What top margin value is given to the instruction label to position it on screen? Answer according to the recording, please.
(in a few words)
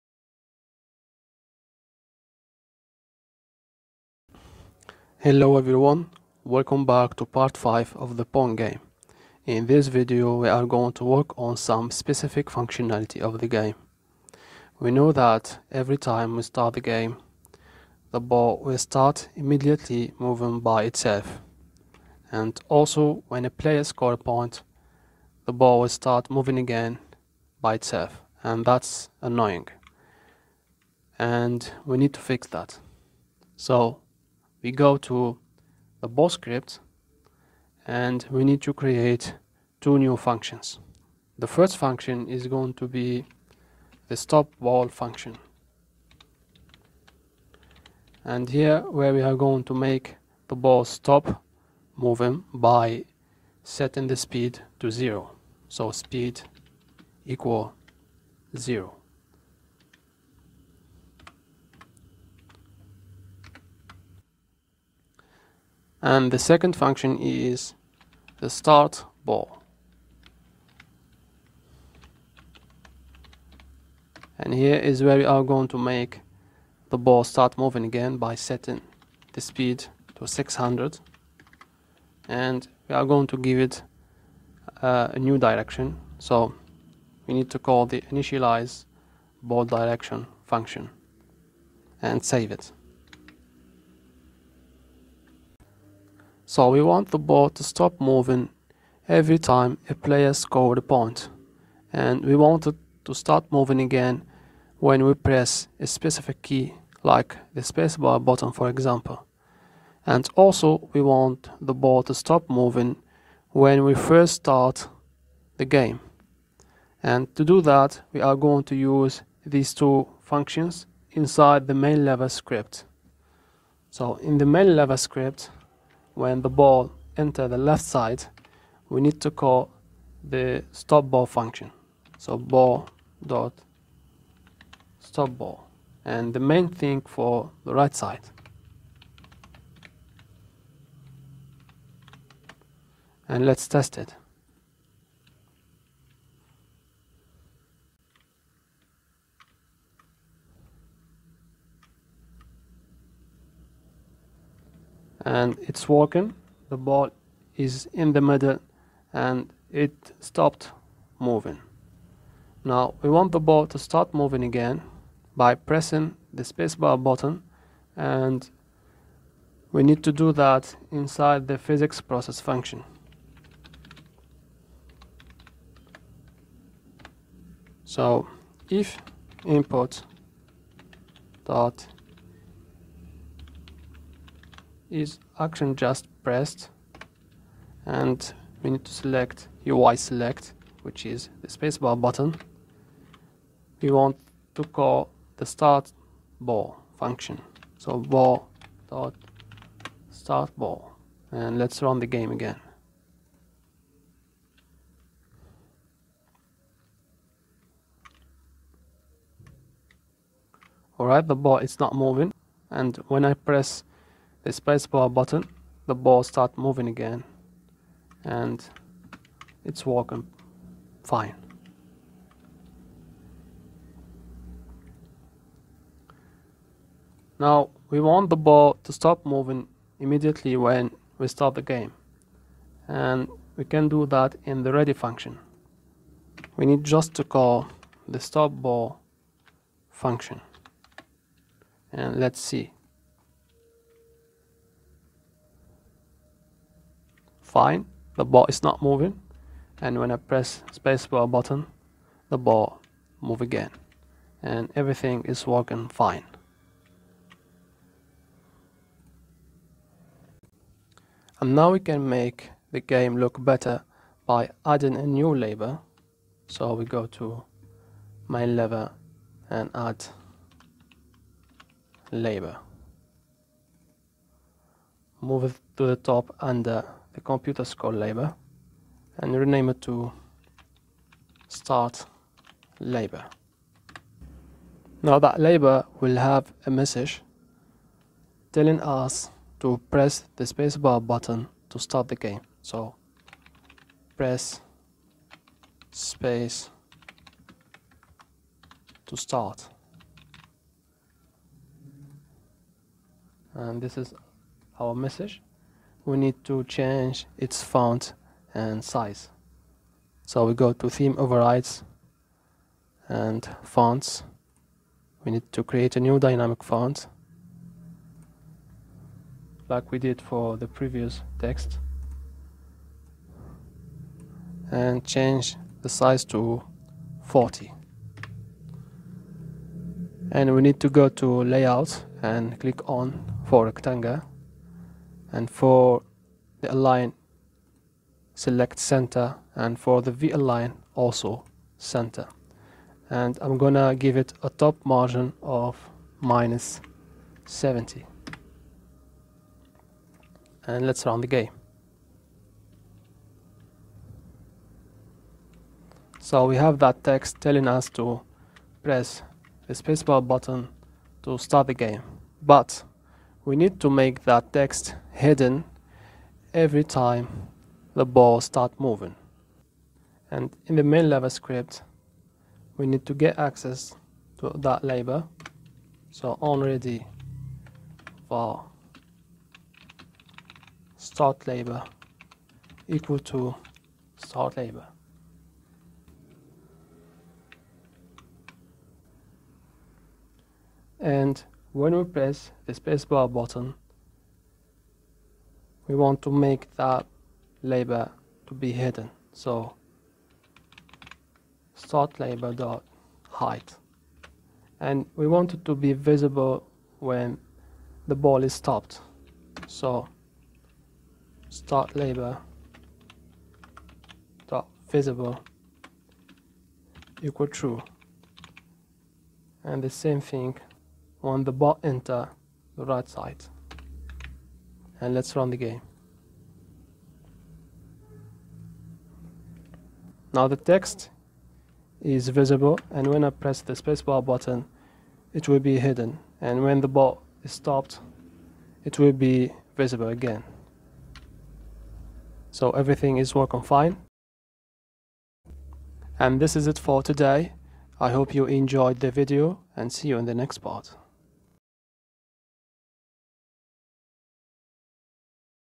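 -70.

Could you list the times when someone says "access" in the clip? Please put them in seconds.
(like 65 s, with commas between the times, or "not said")
373 s.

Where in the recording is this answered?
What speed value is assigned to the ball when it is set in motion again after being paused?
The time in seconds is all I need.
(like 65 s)
80 s.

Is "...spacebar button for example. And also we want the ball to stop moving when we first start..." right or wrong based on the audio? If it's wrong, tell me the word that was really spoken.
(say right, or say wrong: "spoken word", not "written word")
right.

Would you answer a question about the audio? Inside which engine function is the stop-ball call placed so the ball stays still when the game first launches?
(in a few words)
ready function.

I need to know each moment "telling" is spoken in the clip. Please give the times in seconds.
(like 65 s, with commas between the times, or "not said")
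288 s, 357 s.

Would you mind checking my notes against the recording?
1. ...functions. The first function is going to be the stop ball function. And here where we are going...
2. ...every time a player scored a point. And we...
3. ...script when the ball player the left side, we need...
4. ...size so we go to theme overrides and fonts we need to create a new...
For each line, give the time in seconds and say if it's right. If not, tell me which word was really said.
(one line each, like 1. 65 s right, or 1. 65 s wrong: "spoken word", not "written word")
1. 40 s right
2. 99 s right
3. 124 s wrong: "enter", not "player"
4. 308 s right.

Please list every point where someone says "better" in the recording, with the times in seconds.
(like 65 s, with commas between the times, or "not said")
263 s.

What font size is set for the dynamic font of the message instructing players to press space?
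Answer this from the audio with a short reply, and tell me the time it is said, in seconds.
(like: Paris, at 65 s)
40, at 327 s.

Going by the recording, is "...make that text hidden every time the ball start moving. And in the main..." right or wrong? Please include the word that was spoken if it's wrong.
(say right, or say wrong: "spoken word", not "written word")
right.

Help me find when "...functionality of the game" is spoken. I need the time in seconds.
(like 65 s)
12 s.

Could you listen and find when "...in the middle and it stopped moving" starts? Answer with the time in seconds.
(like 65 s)
158 s.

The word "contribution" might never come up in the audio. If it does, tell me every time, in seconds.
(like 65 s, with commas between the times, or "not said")
not said.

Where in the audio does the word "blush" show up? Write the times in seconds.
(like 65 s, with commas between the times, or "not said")
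not said.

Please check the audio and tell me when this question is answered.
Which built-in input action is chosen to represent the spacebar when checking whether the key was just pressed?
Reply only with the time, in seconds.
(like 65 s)
189 s.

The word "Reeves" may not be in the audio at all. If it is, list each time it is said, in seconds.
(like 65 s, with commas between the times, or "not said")
not said.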